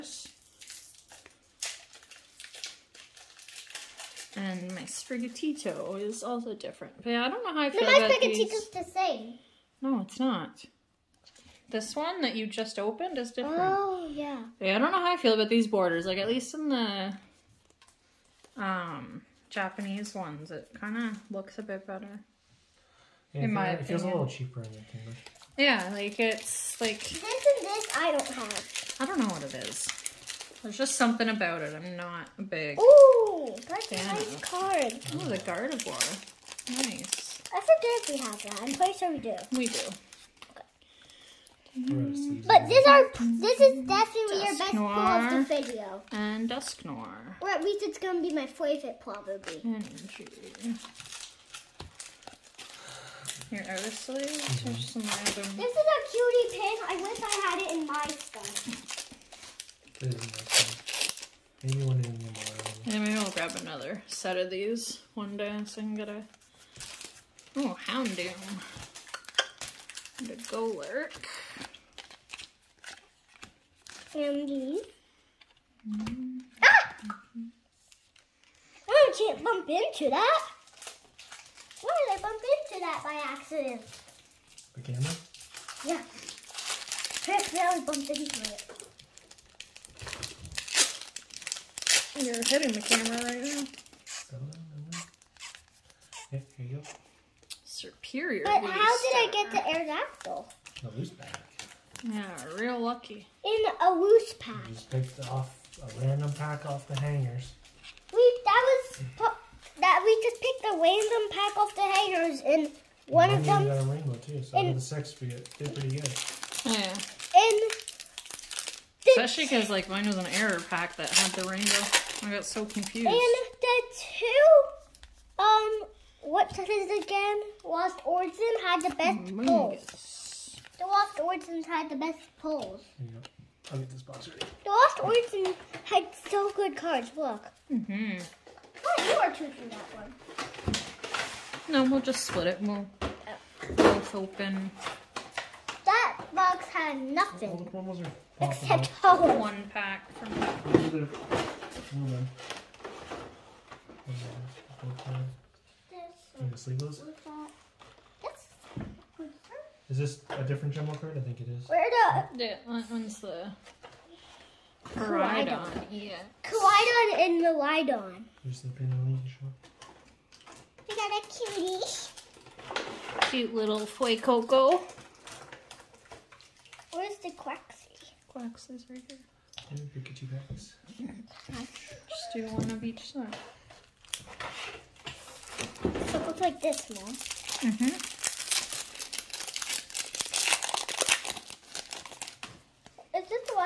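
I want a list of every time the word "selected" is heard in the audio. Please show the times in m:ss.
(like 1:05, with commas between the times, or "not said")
not said.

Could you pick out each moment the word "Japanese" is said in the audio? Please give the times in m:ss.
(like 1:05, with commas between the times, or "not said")
0:19.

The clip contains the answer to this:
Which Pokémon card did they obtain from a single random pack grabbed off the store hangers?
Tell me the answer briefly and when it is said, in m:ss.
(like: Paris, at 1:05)
Aerodactyl, at 1:39.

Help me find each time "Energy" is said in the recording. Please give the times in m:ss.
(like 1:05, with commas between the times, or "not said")
0:49.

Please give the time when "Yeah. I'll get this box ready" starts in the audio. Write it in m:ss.
2:12.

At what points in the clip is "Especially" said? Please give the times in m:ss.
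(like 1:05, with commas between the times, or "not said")
1:59.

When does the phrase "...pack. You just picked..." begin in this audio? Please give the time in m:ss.
1:44.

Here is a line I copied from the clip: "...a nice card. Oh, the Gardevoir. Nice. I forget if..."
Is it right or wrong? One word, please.
right.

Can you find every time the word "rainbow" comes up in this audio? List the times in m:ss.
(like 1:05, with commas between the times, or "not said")
1:53, 2:01.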